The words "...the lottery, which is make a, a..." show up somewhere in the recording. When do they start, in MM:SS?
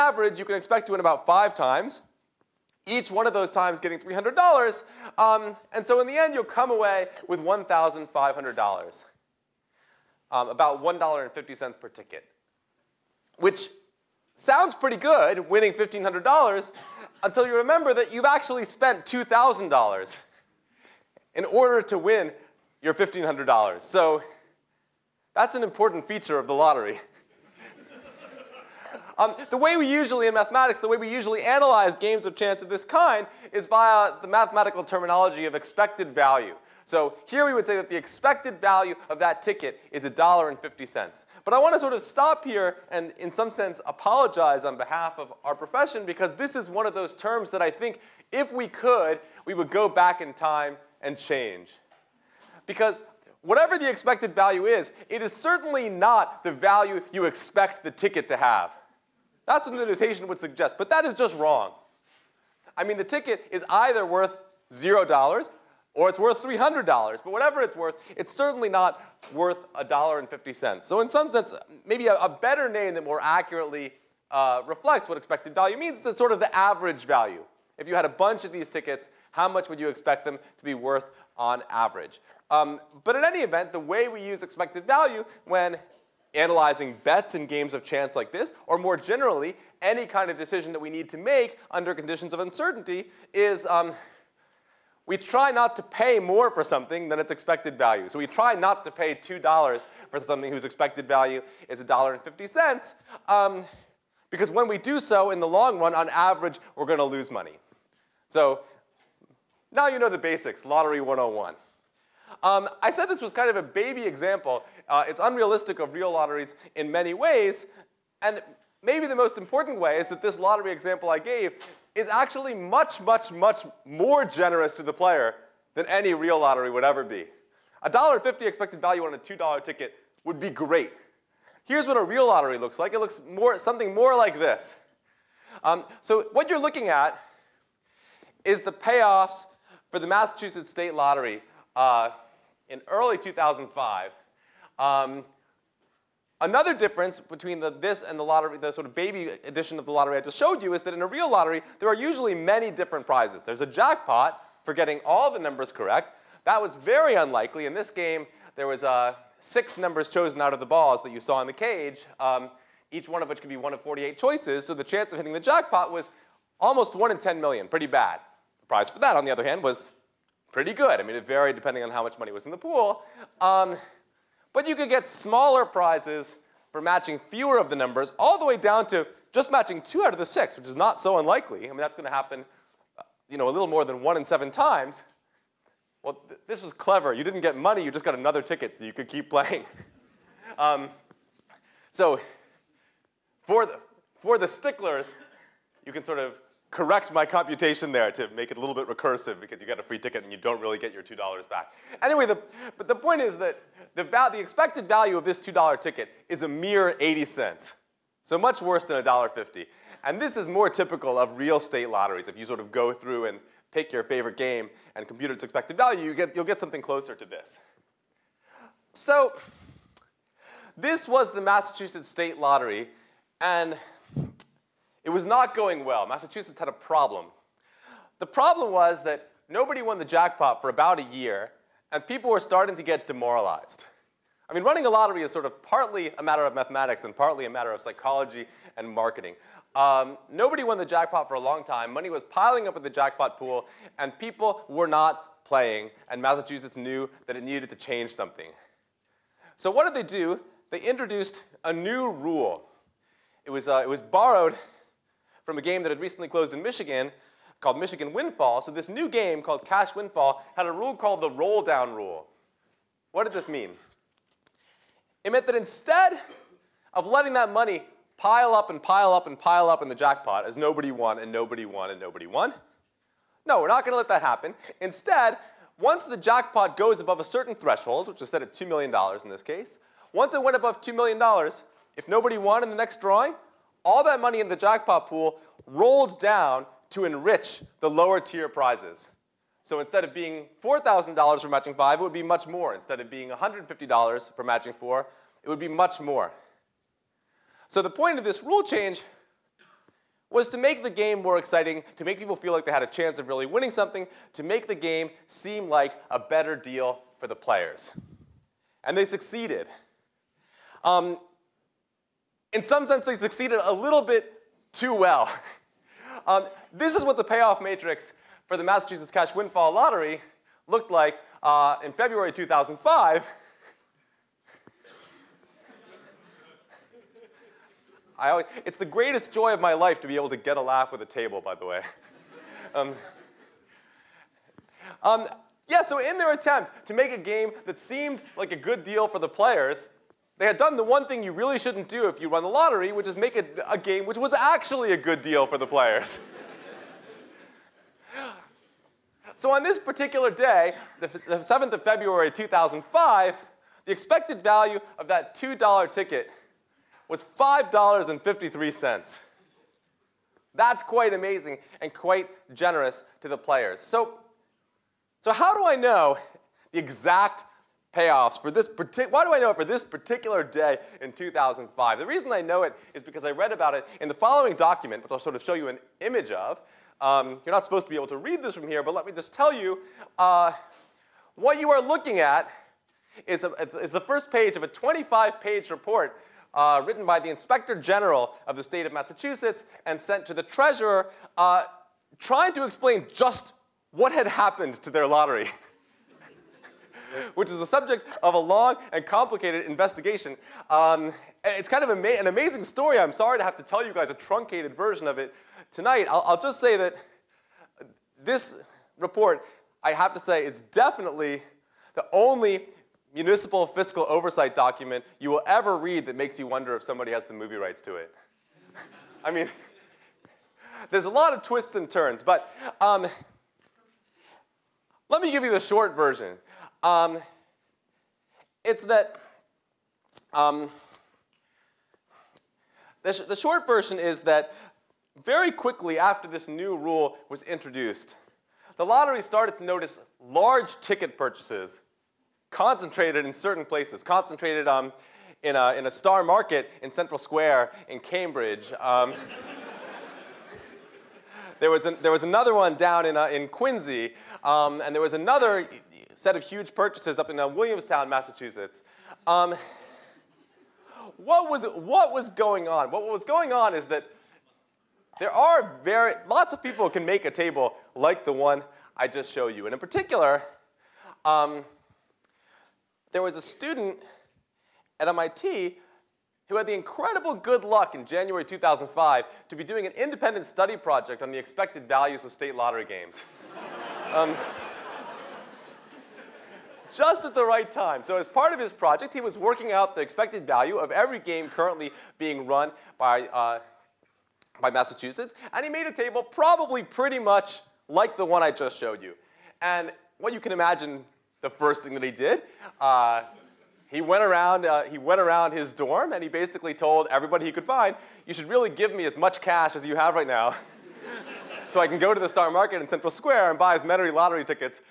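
05:42.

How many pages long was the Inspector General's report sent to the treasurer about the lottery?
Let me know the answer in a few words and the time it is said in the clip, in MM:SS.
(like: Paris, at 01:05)
25, at 06:24.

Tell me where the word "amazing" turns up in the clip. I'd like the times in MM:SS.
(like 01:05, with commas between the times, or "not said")
06:01, 06:42.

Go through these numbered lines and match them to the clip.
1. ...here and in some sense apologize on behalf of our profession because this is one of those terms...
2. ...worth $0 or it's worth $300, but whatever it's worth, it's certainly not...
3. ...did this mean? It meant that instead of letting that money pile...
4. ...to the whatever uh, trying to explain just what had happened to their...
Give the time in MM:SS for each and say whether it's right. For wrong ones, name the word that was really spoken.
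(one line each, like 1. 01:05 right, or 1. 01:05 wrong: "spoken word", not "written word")
1. 00:42 right
2. 01:04 right
3. 04:23 right
4. 06:30 wrong: "treasurer", not "whatever".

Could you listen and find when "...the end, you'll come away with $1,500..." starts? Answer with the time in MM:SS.
00:06.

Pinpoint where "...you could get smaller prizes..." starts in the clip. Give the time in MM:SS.
02:54.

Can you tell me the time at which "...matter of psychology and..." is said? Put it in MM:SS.
03:57.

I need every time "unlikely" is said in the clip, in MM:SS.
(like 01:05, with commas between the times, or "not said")
02:37, 03:01.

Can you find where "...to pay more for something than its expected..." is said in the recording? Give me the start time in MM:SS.
01:35.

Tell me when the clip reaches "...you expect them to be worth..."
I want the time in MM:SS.
01:19.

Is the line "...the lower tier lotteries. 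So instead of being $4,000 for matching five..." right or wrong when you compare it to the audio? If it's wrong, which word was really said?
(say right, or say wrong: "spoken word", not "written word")
wrong: "prizes", not "lotteries".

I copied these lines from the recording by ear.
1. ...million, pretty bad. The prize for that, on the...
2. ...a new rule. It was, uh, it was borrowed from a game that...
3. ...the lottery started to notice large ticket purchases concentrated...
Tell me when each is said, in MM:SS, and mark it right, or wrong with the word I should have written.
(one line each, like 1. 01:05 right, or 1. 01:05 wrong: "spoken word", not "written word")
1. 02:47 right
2. 04:11 right
3. 07:18 right.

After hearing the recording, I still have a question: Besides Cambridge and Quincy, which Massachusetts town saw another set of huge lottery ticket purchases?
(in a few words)
Williamstown.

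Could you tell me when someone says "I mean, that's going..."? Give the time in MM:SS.
03:01.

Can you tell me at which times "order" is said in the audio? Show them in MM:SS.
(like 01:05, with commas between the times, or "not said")
00:21.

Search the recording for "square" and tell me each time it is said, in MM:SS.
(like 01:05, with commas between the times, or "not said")
07:27, 08:33.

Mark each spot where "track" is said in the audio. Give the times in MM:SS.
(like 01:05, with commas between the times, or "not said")
not said.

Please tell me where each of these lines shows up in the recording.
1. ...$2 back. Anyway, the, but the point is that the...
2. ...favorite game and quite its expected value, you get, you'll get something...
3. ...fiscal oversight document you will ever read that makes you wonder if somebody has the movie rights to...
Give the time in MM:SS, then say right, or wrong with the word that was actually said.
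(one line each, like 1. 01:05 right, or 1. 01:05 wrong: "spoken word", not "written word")
1. 03:21 right
2. 03:34 wrong: "compute", not "quite"
3. 06:53 right.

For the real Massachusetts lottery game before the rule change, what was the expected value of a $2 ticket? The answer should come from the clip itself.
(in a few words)
80 cents.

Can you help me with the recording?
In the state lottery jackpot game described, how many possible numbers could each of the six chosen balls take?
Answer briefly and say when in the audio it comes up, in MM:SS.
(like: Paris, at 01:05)
48, at 02:43.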